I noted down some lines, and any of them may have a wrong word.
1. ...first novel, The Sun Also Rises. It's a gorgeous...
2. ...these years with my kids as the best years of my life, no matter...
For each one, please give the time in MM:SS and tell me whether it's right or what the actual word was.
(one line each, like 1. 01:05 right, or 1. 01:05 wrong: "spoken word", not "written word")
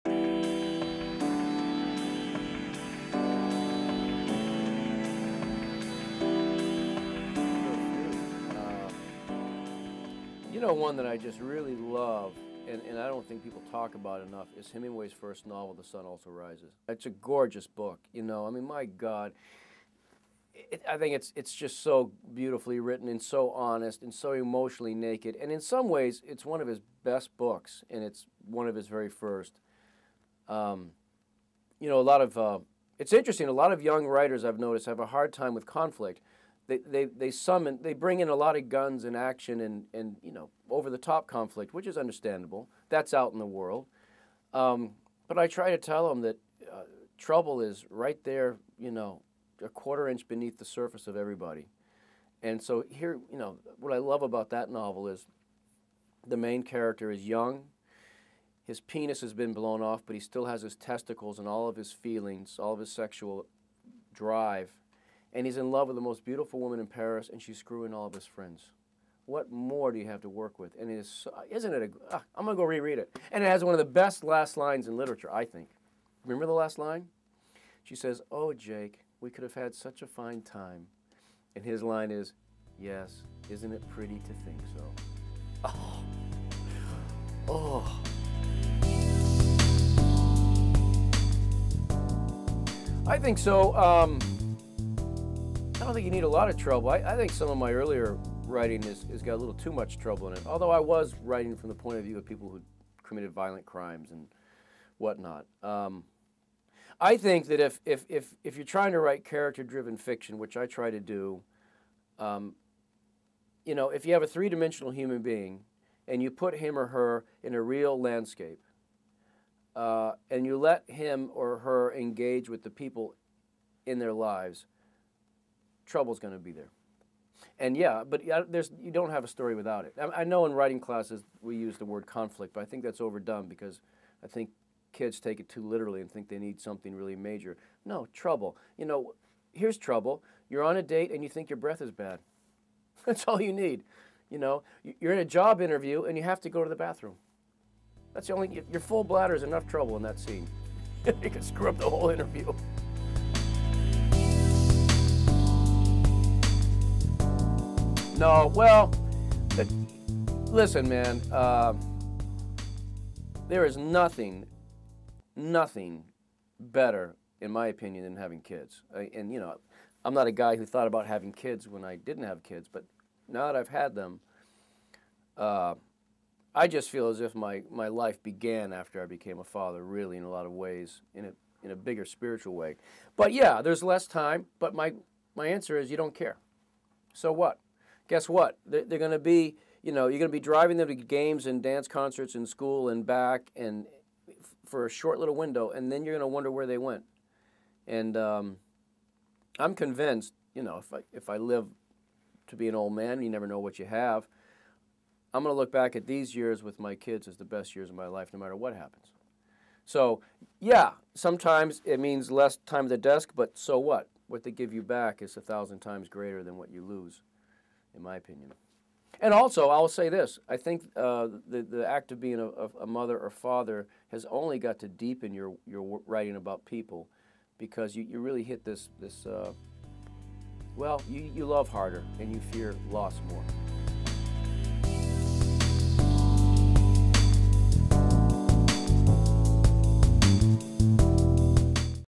1. 00:15 right
2. 03:26 right.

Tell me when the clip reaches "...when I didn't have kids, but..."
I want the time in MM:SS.
02:51.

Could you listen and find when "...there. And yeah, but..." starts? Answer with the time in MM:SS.
02:06.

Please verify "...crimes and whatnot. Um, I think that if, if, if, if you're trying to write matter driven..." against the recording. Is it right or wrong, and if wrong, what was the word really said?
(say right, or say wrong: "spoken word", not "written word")
wrong: "character", not "matter".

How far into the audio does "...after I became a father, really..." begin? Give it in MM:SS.
02:58.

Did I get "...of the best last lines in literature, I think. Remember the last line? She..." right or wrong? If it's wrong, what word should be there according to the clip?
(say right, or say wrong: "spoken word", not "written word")
right.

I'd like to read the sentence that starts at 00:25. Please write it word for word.
And in some ways, it's one of his best books, and it's one of his very first.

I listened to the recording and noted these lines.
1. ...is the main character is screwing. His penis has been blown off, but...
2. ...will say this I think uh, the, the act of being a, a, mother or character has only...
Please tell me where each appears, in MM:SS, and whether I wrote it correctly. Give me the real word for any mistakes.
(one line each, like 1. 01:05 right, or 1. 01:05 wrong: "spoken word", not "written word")
1. 00:55 wrong: "young", not "screwing"
2. 03:39 wrong: "father", not "character".